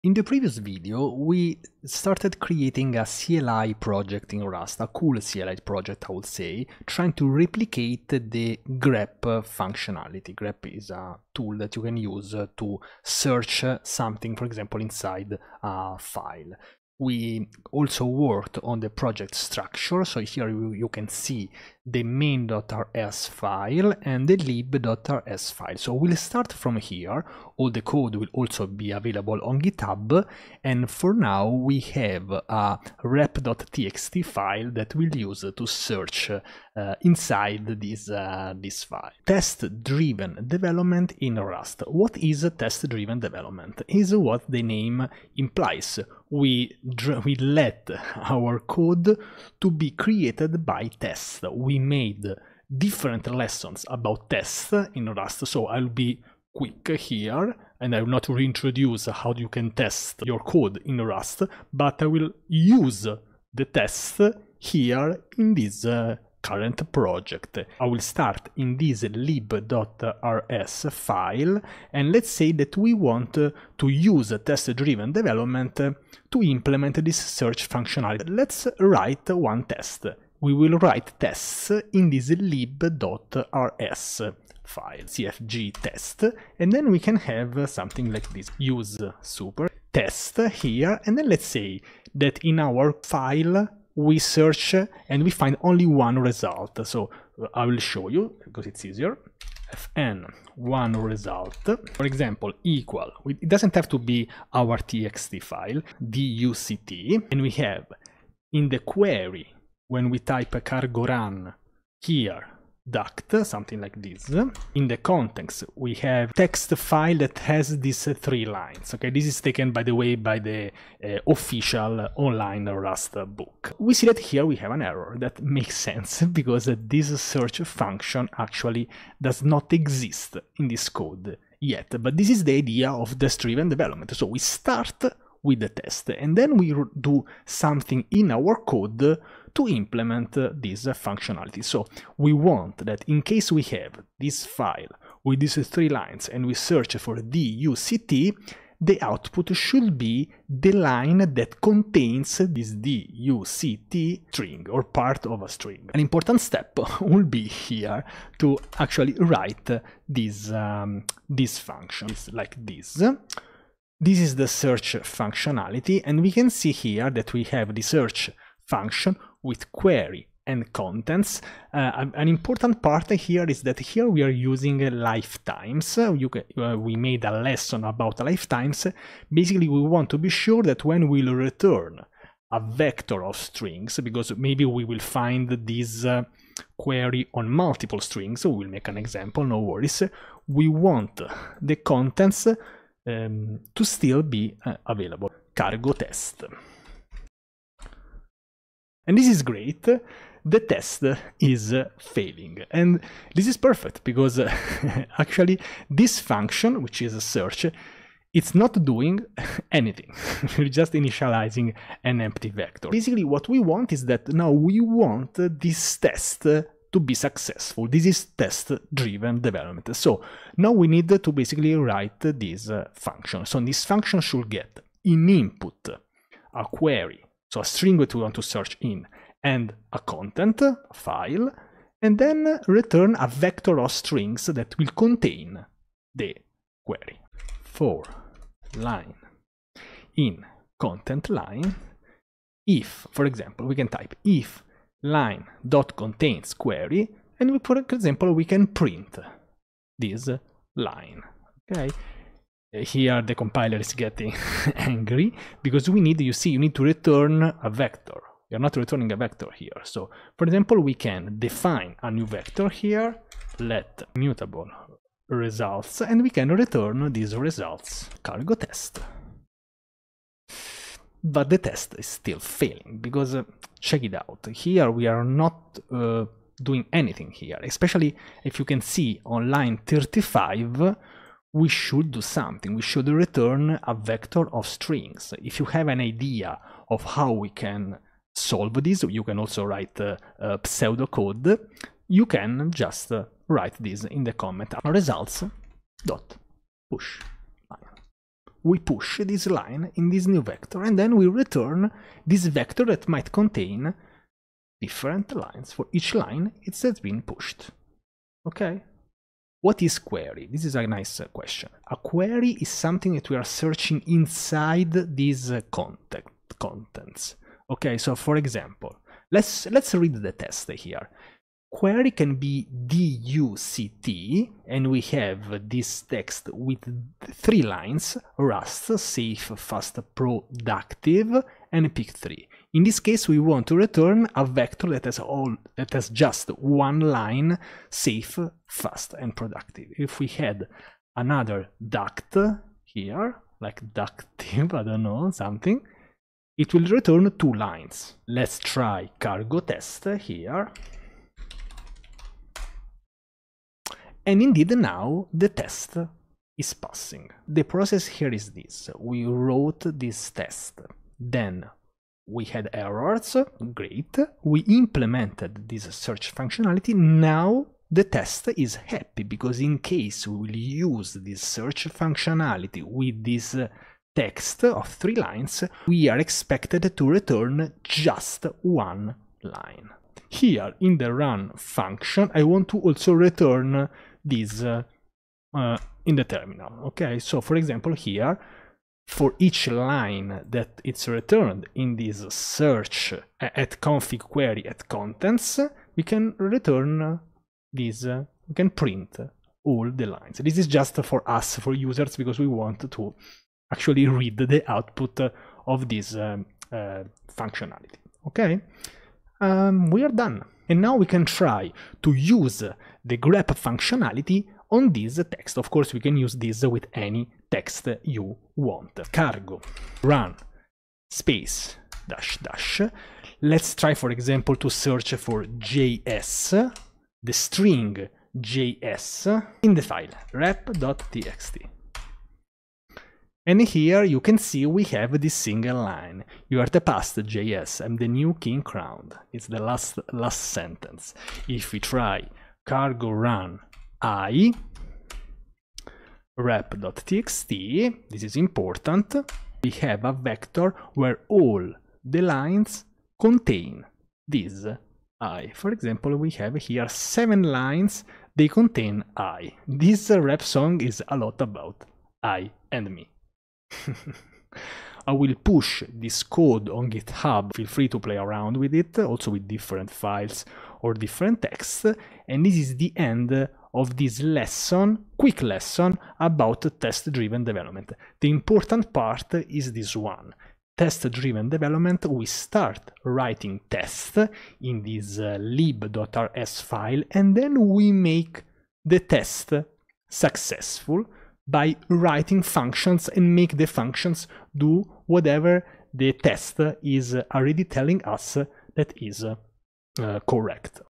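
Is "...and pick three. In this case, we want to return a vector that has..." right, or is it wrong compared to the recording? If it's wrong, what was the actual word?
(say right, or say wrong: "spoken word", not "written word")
right.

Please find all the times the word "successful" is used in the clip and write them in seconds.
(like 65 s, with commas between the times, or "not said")
217 s, 490 s.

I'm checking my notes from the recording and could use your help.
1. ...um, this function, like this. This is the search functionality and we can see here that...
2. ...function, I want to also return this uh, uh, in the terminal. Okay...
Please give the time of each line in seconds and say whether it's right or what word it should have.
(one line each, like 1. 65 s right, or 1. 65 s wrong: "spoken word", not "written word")
1. 160 s right
2. 381 s right.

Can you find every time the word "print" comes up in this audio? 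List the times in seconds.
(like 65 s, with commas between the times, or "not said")
248 s, 398 s.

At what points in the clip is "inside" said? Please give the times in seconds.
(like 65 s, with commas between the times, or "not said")
14 s, 37 s, 314 s.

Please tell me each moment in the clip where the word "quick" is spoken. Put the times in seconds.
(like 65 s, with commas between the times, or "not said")
56 s, 475 s.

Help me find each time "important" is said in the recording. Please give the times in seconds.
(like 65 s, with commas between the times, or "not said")
155 s, 172 s, 448 s, 478 s.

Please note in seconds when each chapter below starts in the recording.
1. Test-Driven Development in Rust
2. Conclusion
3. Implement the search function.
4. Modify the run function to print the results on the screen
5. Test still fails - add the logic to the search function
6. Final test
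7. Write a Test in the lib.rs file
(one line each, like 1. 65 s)
1. 39 s
2. 471 s
3. 211 s
4. 366 s
5. 268 s
6. 410 s
7. 78 s.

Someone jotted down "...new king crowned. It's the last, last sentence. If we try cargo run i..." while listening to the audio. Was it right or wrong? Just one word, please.
right.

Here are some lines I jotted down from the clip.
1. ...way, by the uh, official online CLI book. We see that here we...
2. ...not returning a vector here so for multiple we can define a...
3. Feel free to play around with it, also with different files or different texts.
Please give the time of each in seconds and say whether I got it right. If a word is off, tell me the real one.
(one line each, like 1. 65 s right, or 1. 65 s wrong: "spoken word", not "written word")
1. 119 s wrong: "Rust", not "CLI"
2. 258 s wrong: "example", not "multiple"
3. 467 s right.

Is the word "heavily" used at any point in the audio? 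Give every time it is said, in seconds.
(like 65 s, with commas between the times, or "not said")
not said.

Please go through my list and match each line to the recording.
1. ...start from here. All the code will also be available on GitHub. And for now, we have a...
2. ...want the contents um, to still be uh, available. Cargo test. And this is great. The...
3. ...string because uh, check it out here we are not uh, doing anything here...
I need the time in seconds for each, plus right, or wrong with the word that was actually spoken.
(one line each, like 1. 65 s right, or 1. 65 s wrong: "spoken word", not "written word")
1. 26 s right
2. 190 s right
3. 272 s wrong: "failing", not "string".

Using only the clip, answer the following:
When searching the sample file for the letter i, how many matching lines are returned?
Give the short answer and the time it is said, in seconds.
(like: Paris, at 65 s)
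7, at 456 s.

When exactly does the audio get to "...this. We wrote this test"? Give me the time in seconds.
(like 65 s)
358 s.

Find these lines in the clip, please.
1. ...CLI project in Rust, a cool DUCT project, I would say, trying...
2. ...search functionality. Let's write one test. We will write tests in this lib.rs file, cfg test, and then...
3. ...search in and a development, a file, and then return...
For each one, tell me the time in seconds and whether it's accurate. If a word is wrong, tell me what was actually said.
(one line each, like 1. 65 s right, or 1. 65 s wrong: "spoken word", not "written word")
1. 3 s wrong: "CLI", not "DUCT"
2. 77 s right
3. 228 s wrong: "content", not "development".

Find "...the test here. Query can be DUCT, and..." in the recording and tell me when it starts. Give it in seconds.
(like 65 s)
320 s.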